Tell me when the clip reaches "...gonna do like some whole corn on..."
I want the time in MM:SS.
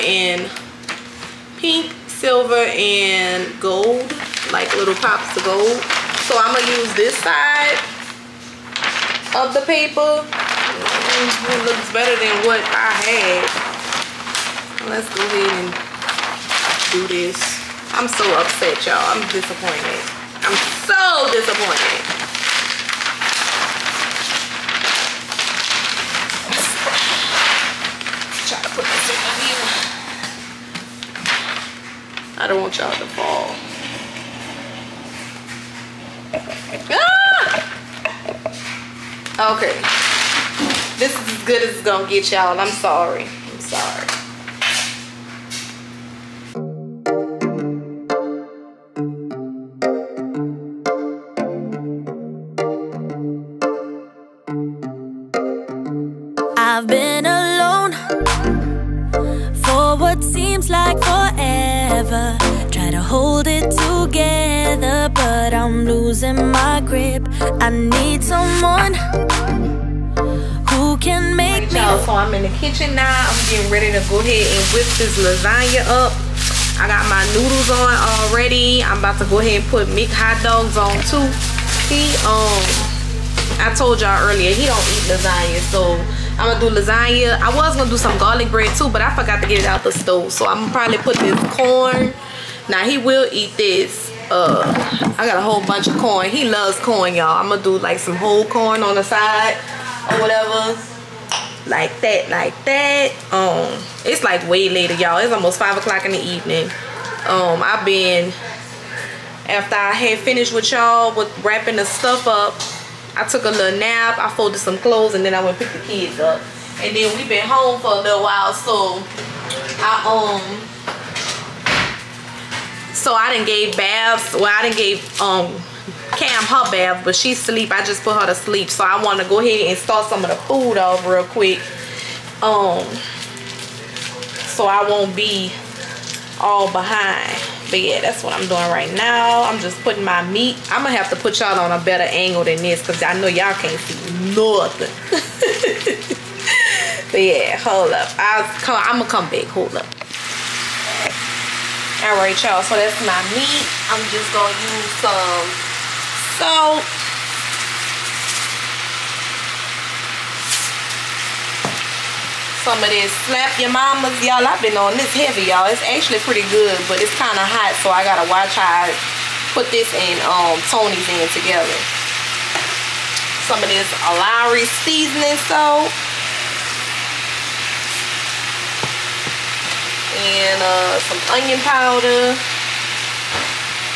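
01:37.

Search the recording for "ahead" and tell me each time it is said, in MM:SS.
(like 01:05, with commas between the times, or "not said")
00:15, 01:14, 01:19, 02:09.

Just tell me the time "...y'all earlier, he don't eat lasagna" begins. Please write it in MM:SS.
01:23.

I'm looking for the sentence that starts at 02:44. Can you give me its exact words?
Y'all, I've been on this heavy, y'all.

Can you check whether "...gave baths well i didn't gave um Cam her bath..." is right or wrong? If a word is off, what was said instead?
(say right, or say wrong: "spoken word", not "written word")
right.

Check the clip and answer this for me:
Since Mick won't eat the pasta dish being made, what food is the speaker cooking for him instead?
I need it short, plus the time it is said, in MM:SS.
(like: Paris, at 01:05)
hot dogs, at 01:20.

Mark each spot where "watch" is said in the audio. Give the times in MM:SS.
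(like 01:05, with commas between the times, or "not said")
02:48.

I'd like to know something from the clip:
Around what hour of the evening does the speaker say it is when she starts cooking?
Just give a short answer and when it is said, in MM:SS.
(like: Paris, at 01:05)
5, at 01:45.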